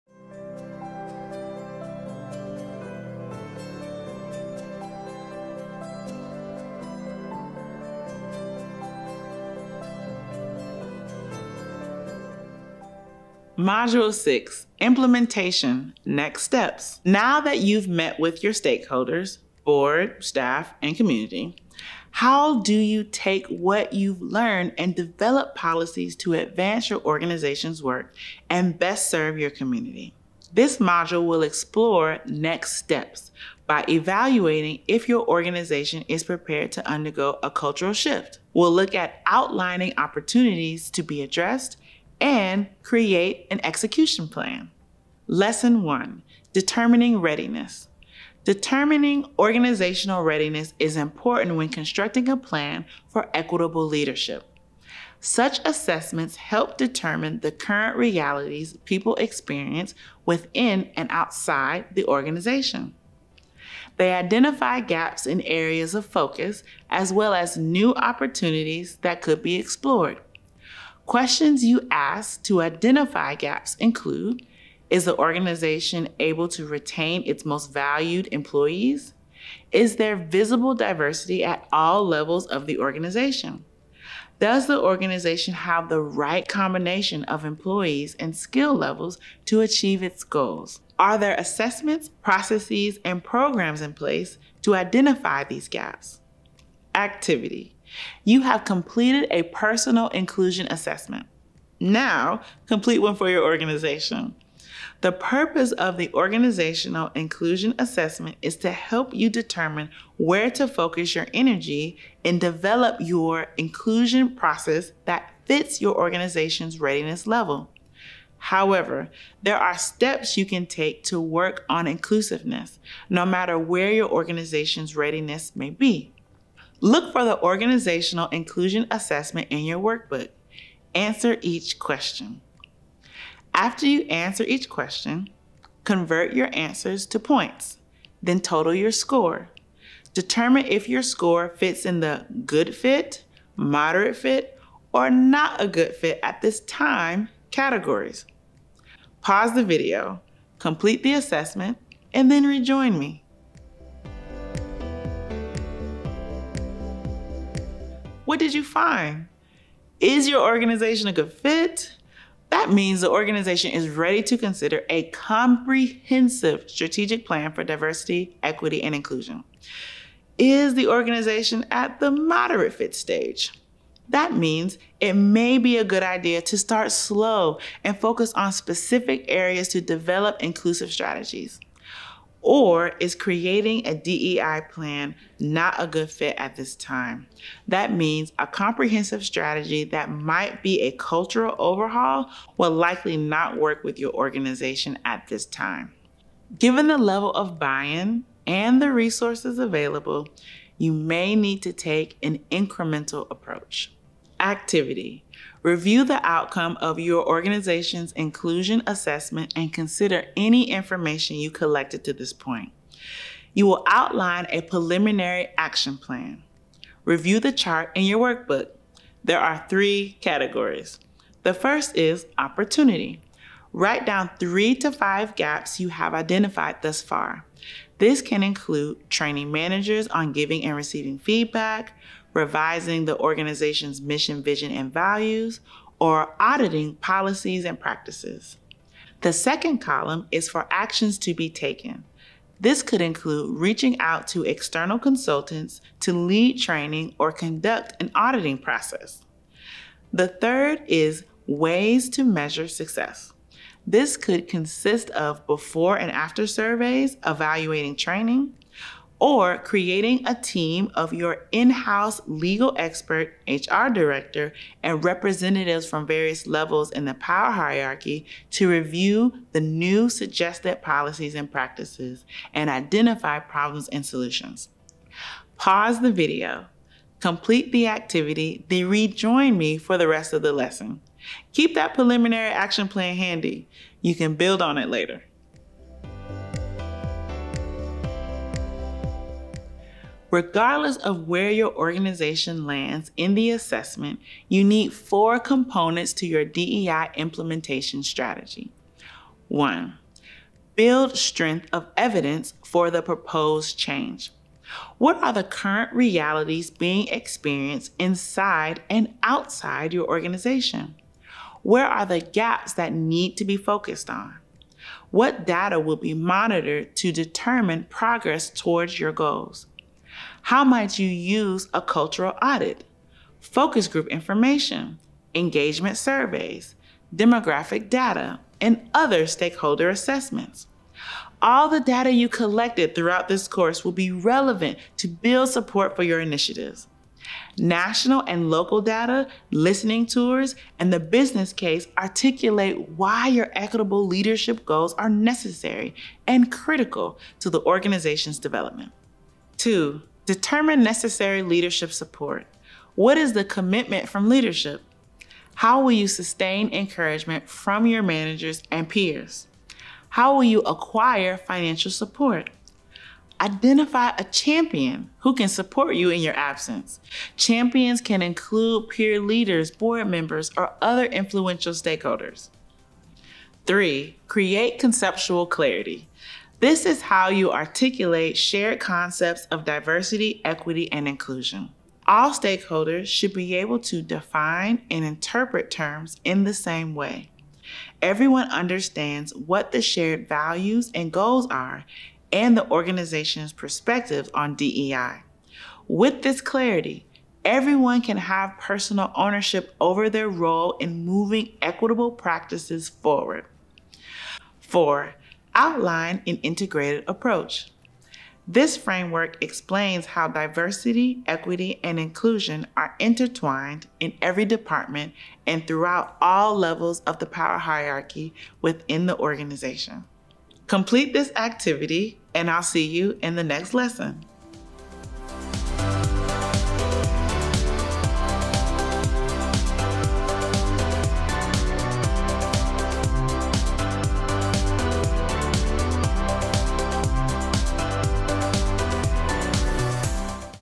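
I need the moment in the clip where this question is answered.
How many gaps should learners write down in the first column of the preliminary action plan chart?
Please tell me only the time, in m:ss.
3:44.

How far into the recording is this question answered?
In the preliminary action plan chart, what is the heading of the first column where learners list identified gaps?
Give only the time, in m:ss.
3:42.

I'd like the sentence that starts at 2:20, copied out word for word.
Determine if your score fits in the good fit, moderate fit, or not a good fit at this time categories.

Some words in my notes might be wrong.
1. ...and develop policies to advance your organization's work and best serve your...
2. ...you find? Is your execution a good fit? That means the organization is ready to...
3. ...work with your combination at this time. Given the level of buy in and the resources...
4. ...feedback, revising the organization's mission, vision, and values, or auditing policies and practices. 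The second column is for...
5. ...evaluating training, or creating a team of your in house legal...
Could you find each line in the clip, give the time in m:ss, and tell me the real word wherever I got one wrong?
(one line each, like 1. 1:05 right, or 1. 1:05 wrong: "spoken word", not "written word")
1. 0:24 right
2. 2:38 wrong: "organization", not "execution"
3. 3:13 wrong: "organization", not "combination"
4. 3:51 right
5. 4:17 right.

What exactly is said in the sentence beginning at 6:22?
All stakeholders should be able to define and interpret terms in the same way.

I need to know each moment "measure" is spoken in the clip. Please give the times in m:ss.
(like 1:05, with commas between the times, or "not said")
4:12.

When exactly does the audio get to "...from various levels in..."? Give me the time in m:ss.
4:25.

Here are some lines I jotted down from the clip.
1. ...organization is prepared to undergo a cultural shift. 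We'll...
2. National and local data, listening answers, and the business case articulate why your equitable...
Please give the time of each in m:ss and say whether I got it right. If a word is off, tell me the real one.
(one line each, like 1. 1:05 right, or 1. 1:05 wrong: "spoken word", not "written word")
1. 0:35 right
2. 5:37 wrong: "tours", not "answers".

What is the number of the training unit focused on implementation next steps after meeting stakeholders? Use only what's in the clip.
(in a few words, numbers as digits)
6.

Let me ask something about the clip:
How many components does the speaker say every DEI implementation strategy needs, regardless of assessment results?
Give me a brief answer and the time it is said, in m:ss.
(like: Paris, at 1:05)
4, at 4:54.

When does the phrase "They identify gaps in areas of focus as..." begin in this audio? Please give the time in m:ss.
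1:03.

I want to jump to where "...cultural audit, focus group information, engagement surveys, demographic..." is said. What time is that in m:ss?
5:21.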